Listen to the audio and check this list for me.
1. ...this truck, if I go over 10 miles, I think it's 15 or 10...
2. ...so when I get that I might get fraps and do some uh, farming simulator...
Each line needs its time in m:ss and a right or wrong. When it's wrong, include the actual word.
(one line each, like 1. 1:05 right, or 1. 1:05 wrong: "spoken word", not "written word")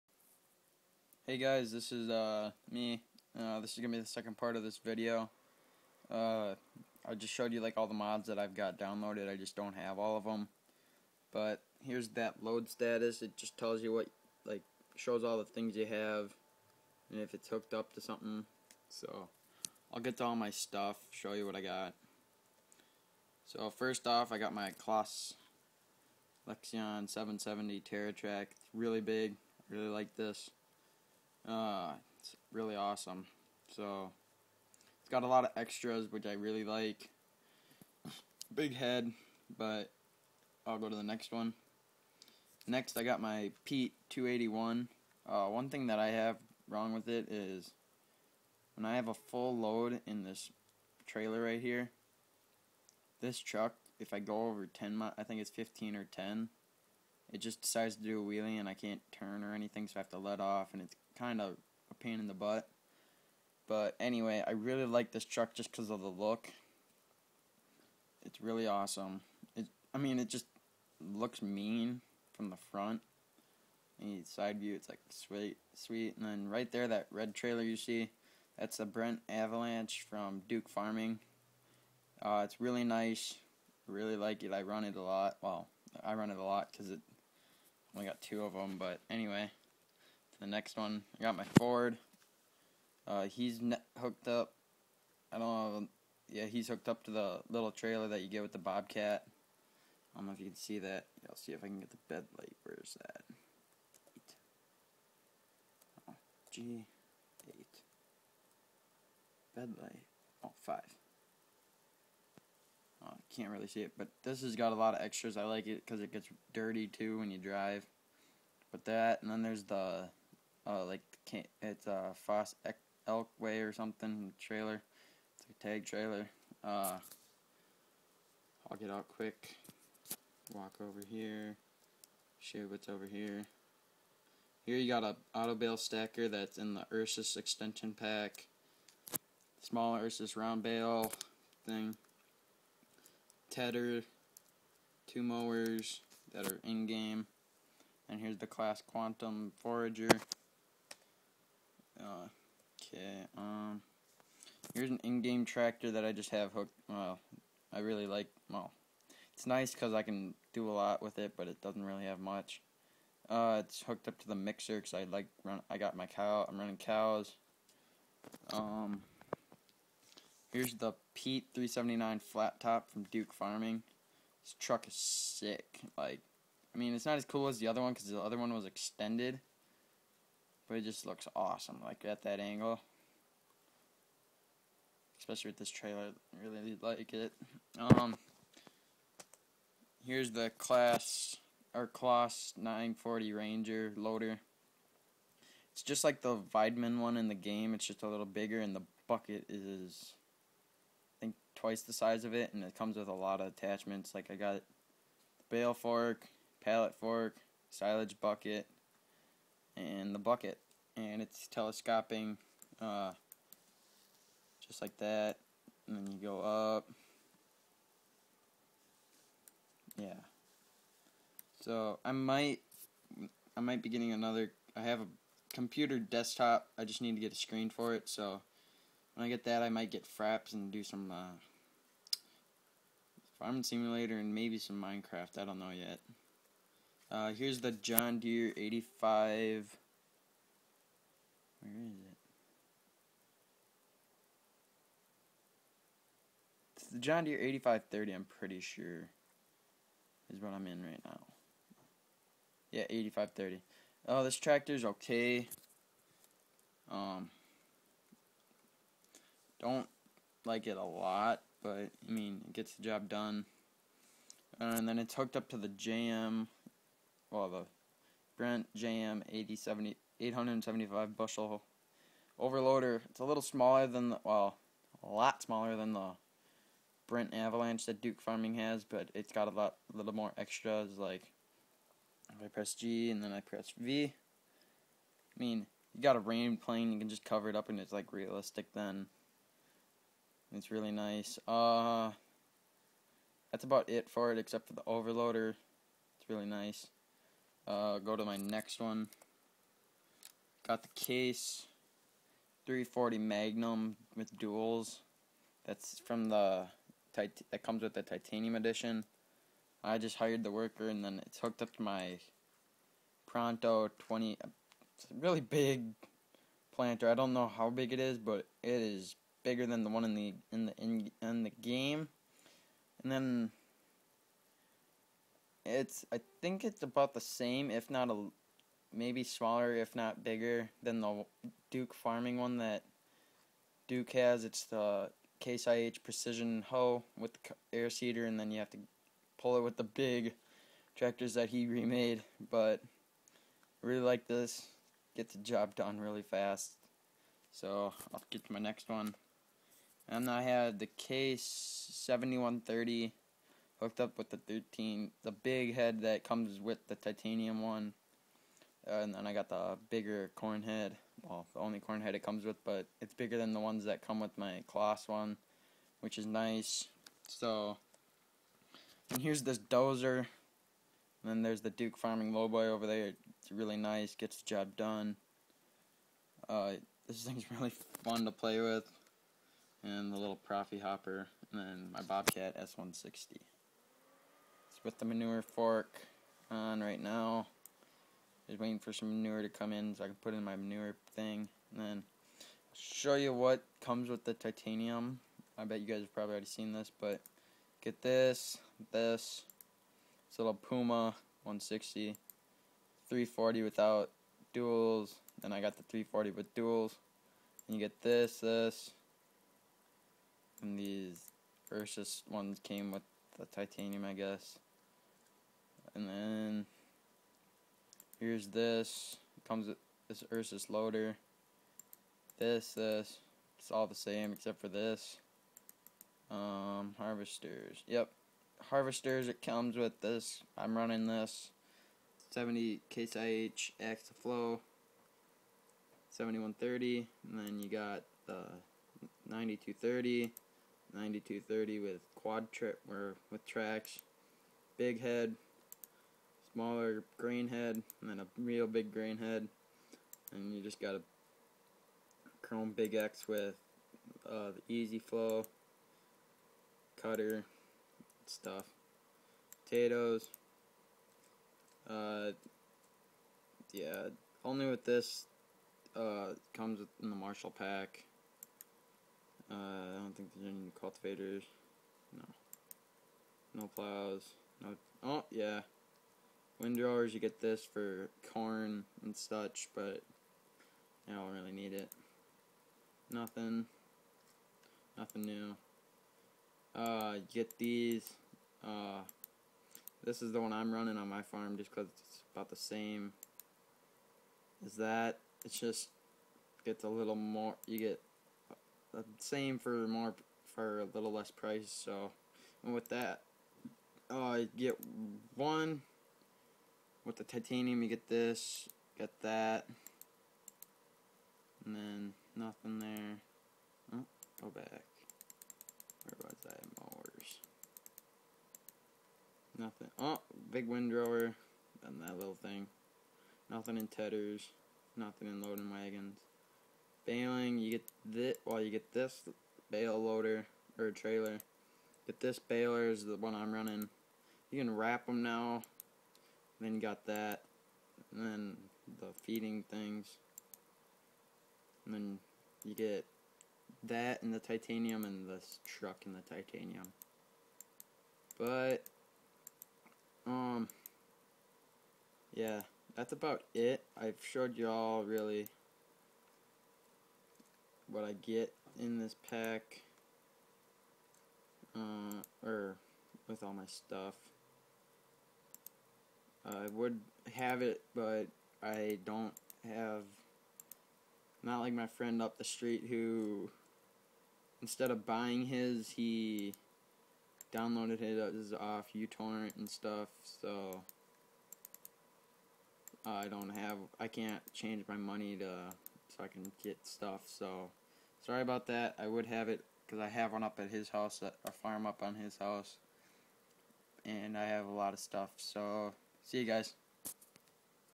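1. 0:53 right
2. 3:48 right.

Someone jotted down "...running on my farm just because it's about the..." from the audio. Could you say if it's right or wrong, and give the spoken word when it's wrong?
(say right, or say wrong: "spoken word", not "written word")
right.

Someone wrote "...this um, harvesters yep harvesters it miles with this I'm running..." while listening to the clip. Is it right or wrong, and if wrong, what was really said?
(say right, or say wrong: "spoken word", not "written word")
wrong: "comes", not "miles".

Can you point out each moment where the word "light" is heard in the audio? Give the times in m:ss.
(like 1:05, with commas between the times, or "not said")
1:42, 1:49.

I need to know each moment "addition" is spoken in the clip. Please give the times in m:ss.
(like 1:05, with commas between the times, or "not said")
not said.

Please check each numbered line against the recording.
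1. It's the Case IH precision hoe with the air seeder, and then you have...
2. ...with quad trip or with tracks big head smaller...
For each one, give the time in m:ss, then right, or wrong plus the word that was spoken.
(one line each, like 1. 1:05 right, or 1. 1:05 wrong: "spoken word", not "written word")
1. 5:34 right
2. 7:21 right.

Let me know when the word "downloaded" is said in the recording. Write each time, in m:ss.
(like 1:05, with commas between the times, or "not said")
0:08, 9:37.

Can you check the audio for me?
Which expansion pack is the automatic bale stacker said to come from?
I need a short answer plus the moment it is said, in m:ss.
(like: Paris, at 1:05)
Ursus extension pack, at 2:16.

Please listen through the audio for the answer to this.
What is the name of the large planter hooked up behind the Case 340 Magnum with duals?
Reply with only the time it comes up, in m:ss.
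5:13.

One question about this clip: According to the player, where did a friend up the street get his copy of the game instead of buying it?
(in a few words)
uTorrent.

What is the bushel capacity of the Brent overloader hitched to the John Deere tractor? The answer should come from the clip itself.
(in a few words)
875 bushel.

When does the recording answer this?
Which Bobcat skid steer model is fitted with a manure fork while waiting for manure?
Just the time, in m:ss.
6:22.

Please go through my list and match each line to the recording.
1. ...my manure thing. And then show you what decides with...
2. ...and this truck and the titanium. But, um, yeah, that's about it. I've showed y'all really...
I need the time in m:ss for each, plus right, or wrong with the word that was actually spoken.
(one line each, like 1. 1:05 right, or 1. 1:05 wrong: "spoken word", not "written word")
1. 6:30 wrong: "comes", not "decides"
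2. 9:05 right.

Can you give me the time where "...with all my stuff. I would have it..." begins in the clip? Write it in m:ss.
9:23.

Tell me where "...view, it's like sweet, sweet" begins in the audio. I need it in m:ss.
1:14.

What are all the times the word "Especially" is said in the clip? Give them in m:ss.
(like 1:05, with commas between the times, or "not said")
3:05.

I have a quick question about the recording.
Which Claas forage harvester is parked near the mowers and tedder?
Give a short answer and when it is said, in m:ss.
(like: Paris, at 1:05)
Claas Quantum Forager, at 2:28.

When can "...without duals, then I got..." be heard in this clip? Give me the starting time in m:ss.
6:43.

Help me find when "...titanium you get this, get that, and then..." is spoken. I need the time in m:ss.
8:27.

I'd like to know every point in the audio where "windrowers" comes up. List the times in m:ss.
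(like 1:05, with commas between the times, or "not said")
7:56, 8:40.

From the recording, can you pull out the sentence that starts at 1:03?
But anyway, I really like this truck just because of the look.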